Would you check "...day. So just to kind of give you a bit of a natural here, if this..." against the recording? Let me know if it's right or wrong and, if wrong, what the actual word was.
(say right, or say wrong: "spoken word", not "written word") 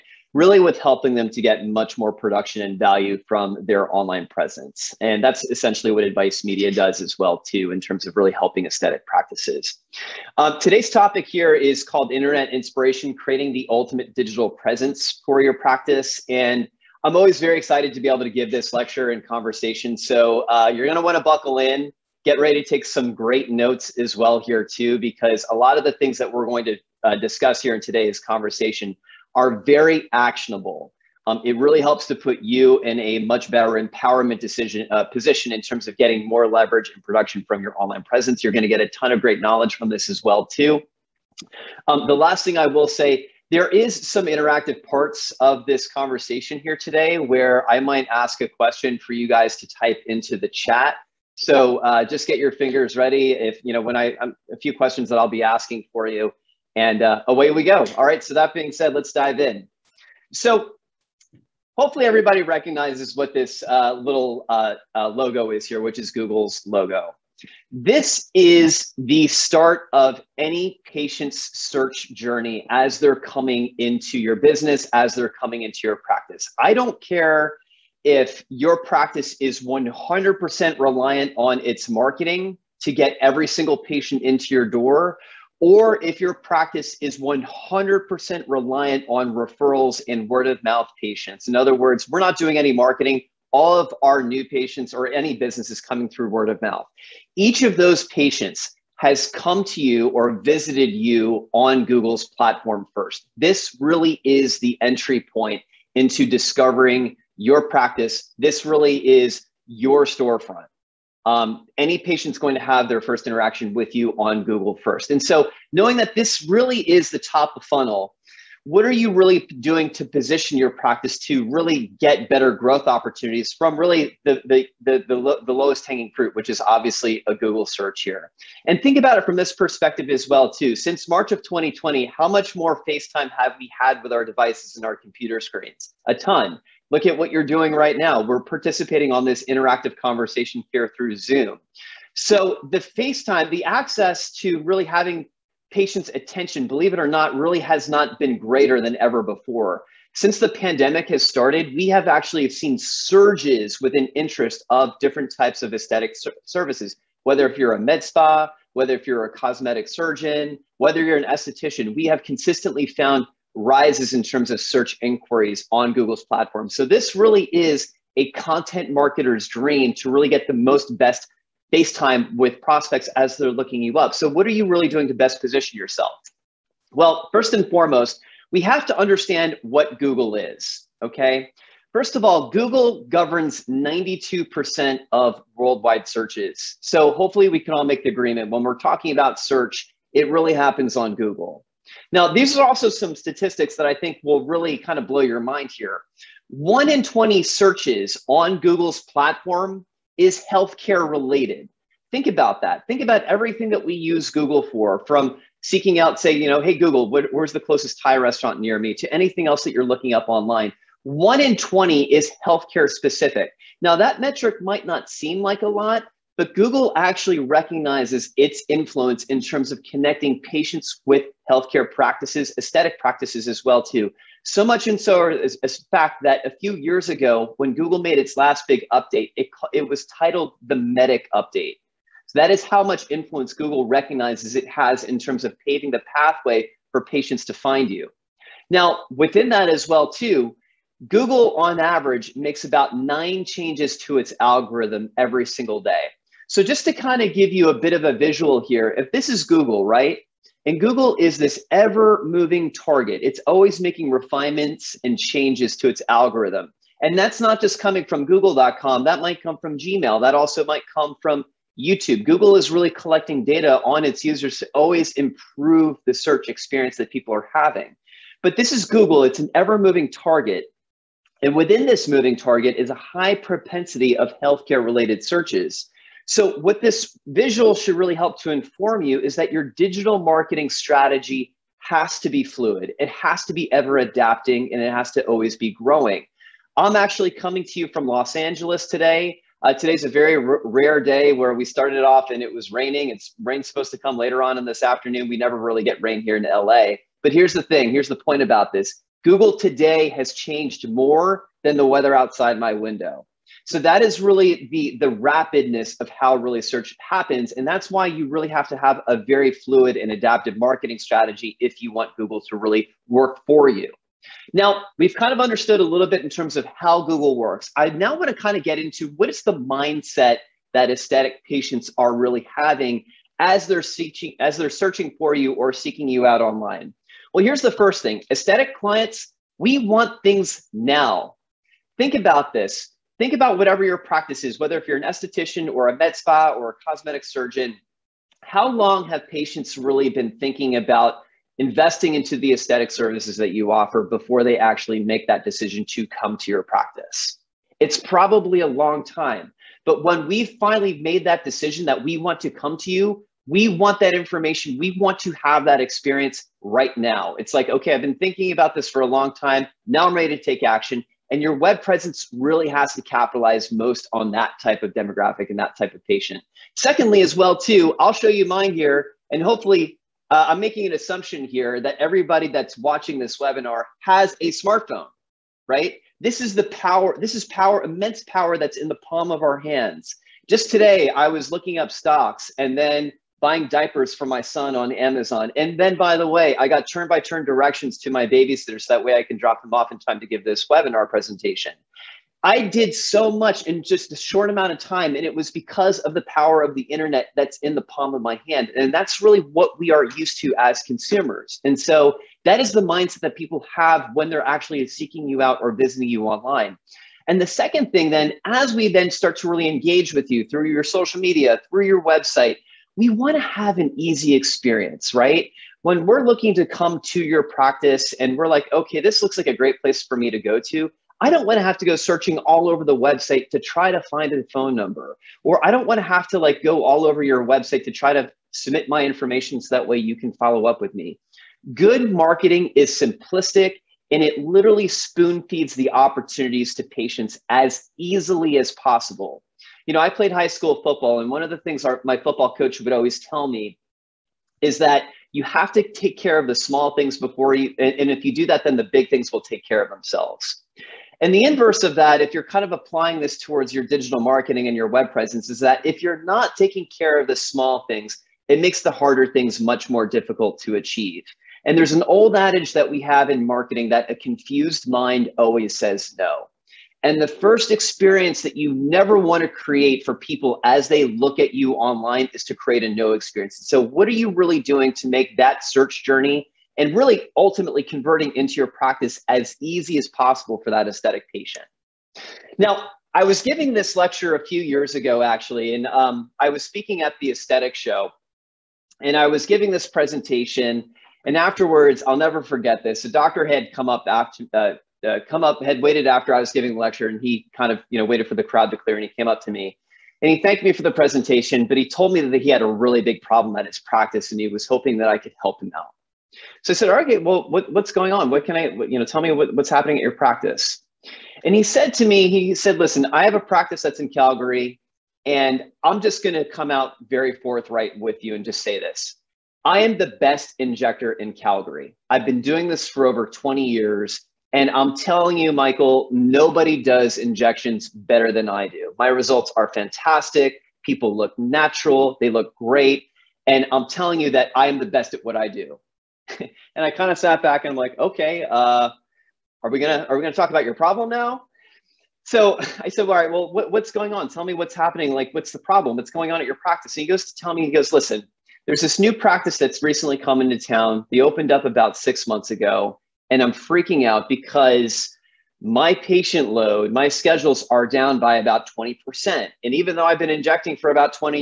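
wrong: "visual", not "natural".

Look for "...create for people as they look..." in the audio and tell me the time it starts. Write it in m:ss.
7:49.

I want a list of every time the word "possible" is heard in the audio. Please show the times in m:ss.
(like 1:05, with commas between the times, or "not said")
7:18, 8:00.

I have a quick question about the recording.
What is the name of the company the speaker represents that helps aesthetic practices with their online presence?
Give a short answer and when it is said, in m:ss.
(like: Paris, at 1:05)
Advice Media, at 0:06.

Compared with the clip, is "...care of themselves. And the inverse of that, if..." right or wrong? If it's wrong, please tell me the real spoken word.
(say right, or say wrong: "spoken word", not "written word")
right.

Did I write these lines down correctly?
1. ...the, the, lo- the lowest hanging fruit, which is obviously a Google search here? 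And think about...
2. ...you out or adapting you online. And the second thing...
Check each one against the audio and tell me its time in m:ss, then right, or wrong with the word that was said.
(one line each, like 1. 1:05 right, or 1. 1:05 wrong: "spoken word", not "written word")
1. 2:04 right
2. 6:45 wrong: "visiting", not "adapting".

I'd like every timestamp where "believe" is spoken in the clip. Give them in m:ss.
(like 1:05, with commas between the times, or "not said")
2:26.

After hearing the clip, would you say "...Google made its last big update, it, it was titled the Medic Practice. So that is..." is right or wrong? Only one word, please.
wrong.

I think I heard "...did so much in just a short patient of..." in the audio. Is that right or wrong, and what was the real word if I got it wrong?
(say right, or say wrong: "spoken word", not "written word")
wrong: "amount", not "patient".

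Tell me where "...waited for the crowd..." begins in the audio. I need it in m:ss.
8:18.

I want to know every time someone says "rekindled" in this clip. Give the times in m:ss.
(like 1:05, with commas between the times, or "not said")
not said.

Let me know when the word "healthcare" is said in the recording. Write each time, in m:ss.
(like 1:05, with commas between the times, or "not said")
3:20, 3:32, 3:41, 4:34.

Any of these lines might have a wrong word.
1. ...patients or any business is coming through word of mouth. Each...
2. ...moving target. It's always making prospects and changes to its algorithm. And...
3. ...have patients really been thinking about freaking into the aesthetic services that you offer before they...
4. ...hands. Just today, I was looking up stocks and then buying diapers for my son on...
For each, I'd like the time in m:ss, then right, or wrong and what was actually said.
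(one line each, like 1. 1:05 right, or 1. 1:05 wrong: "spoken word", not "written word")
1. 1:34 right
2. 4:12 wrong: "refinements", not "prospects"
3. 5:39 wrong: "investing", not "freaking"
4. 6:19 right.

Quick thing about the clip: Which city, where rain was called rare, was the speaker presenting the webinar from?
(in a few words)
Los Angeles.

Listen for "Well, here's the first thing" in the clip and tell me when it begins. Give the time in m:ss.
5:27.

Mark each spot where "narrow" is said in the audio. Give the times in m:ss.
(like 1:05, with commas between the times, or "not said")
not said.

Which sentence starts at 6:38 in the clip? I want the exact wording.
And that's really what we are used to as consumers.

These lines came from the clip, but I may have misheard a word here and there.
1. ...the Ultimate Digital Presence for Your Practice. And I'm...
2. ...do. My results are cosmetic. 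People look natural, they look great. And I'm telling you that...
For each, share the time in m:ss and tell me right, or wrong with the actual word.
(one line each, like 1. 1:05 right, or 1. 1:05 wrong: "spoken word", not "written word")
1. 0:13 right
2. 8:48 wrong: "fantastic", not "cosmetic".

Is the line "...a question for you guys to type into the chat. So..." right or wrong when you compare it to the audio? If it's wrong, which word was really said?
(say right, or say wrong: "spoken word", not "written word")
right.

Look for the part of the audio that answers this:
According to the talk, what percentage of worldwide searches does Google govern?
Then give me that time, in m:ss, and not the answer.
3:03.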